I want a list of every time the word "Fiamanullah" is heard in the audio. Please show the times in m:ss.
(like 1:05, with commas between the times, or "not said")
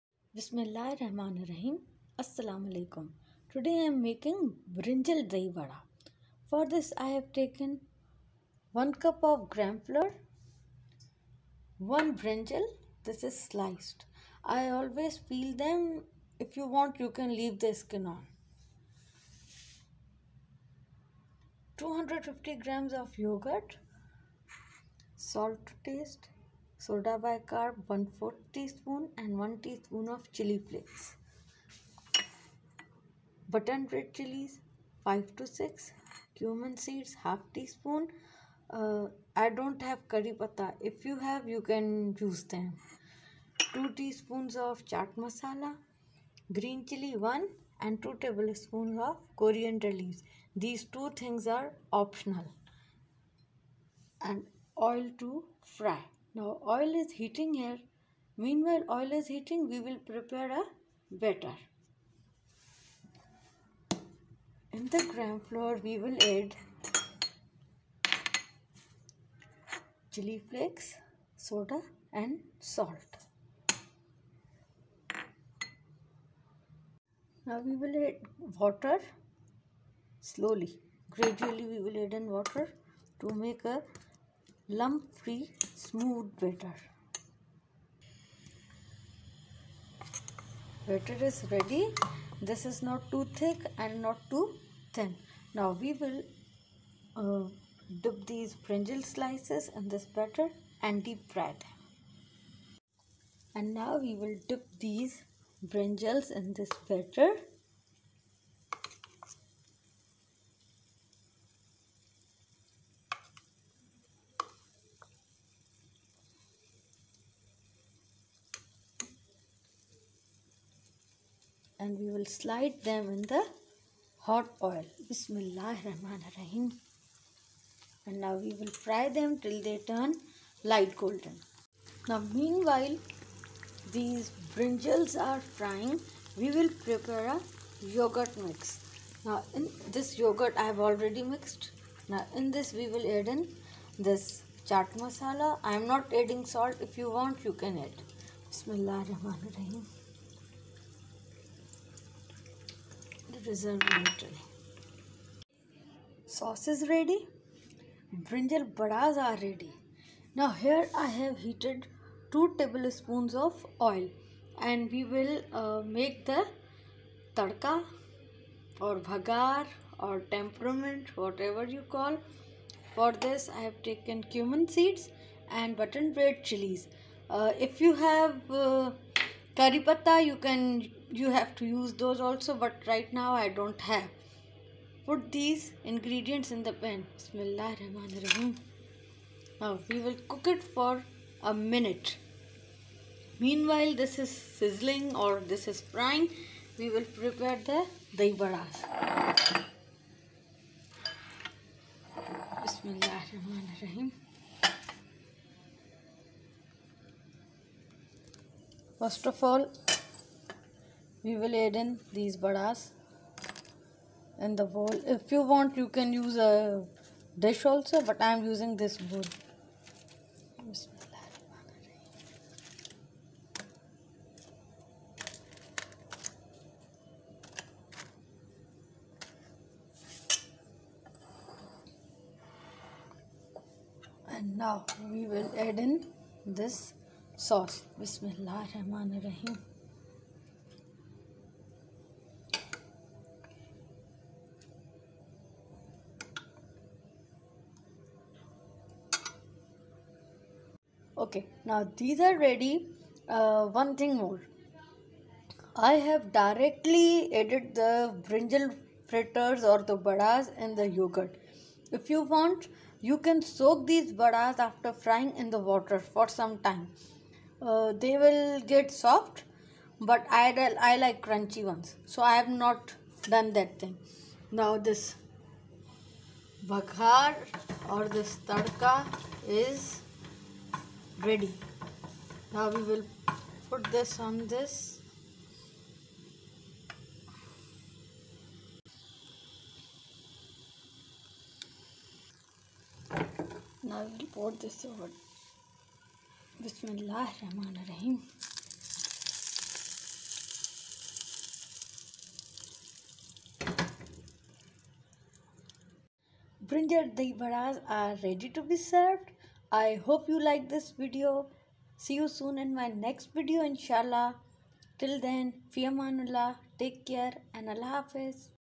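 5:15.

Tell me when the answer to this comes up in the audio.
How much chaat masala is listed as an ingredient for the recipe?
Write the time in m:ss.
0:43.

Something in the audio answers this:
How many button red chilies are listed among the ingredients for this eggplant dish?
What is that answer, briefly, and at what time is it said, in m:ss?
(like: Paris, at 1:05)
5 to 6, at 0:35.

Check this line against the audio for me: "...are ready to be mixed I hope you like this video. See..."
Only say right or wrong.
wrong.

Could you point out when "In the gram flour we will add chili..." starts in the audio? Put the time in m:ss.
1:04.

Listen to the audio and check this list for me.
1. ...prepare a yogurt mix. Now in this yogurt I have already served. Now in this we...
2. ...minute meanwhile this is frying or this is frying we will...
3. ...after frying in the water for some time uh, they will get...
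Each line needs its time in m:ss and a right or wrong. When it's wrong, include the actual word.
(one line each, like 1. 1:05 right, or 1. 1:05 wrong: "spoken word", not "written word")
1. 2:16 wrong: "mixed", not "served"
2. 3:11 wrong: "sizzling", not "frying"
3. 4:24 right.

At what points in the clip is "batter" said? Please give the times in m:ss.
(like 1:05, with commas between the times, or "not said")
1:01, 1:26, 1:30, 1:40, 1:46.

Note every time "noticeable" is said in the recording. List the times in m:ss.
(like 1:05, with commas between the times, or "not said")
not said.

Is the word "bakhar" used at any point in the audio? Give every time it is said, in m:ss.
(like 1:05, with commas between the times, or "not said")
4:36.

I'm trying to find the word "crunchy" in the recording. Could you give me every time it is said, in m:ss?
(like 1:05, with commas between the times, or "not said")
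4:31.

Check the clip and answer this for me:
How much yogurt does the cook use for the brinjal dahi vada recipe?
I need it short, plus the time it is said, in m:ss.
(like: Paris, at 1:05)
250 grams, at 0:21.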